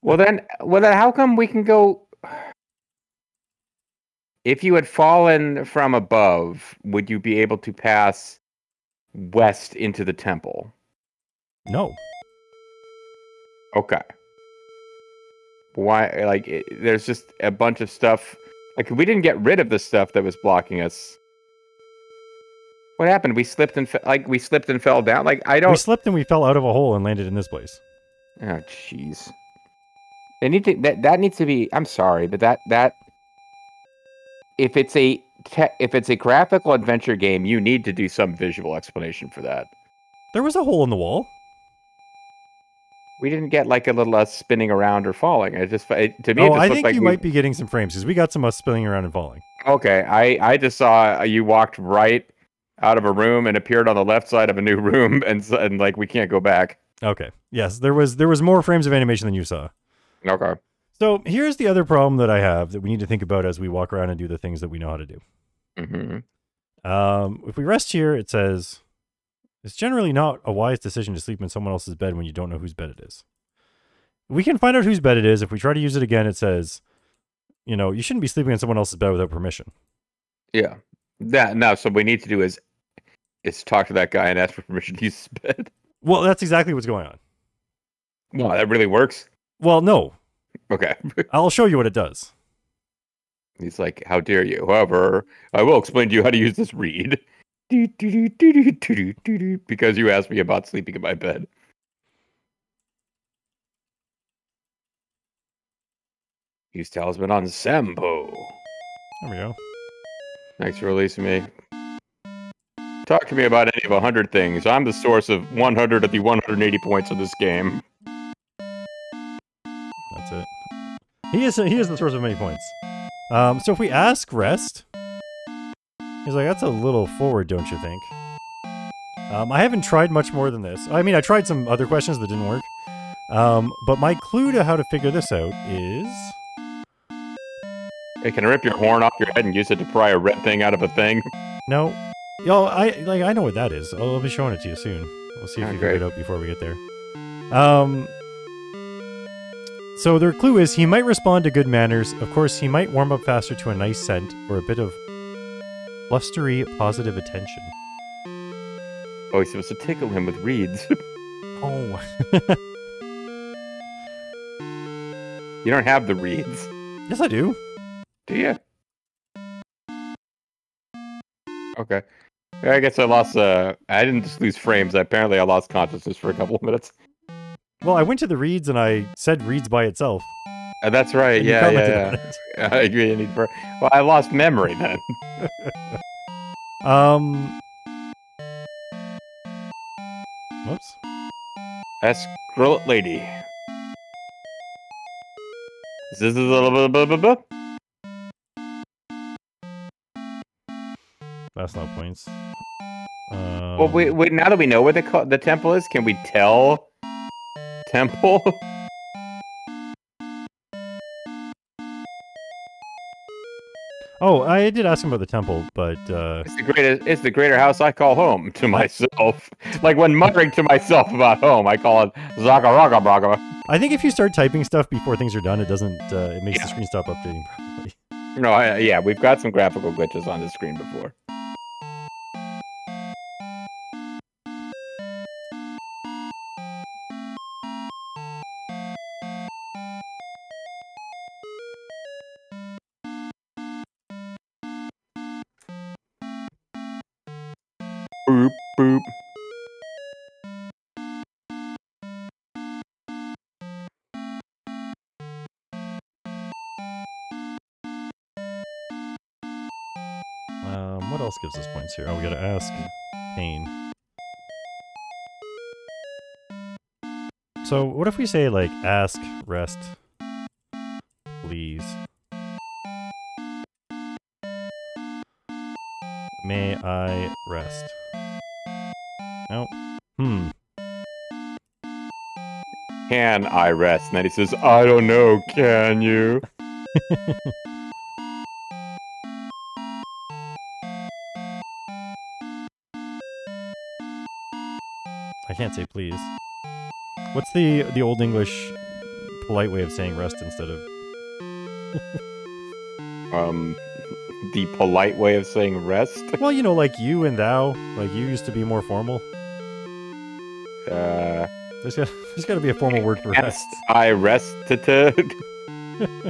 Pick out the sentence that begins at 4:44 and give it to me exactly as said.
And then he says, I don't know, can you?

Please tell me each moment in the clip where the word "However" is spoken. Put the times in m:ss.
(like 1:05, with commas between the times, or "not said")
1:34.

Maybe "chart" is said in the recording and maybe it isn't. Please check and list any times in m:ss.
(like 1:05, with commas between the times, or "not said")
not said.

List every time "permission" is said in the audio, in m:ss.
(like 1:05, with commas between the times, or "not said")
1:19, 1:24.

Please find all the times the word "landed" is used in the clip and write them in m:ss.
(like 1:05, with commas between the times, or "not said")
0:27.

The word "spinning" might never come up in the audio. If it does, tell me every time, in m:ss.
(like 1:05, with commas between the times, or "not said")
0:44, 0:48.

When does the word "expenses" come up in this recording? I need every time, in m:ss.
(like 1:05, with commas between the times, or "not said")
not said.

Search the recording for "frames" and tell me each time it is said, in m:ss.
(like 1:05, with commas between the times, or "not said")
0:47, 0:58, 2:54.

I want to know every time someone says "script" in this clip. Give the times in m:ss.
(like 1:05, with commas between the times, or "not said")
not said.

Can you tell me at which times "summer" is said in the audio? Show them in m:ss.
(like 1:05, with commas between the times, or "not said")
not said.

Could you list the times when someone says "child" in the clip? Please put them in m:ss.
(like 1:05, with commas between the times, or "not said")
not said.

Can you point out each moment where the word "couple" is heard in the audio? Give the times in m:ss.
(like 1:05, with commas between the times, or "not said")
2:56.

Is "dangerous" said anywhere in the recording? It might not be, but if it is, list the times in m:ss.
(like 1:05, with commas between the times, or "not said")
not said.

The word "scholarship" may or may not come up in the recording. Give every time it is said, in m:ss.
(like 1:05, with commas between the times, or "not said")
not said.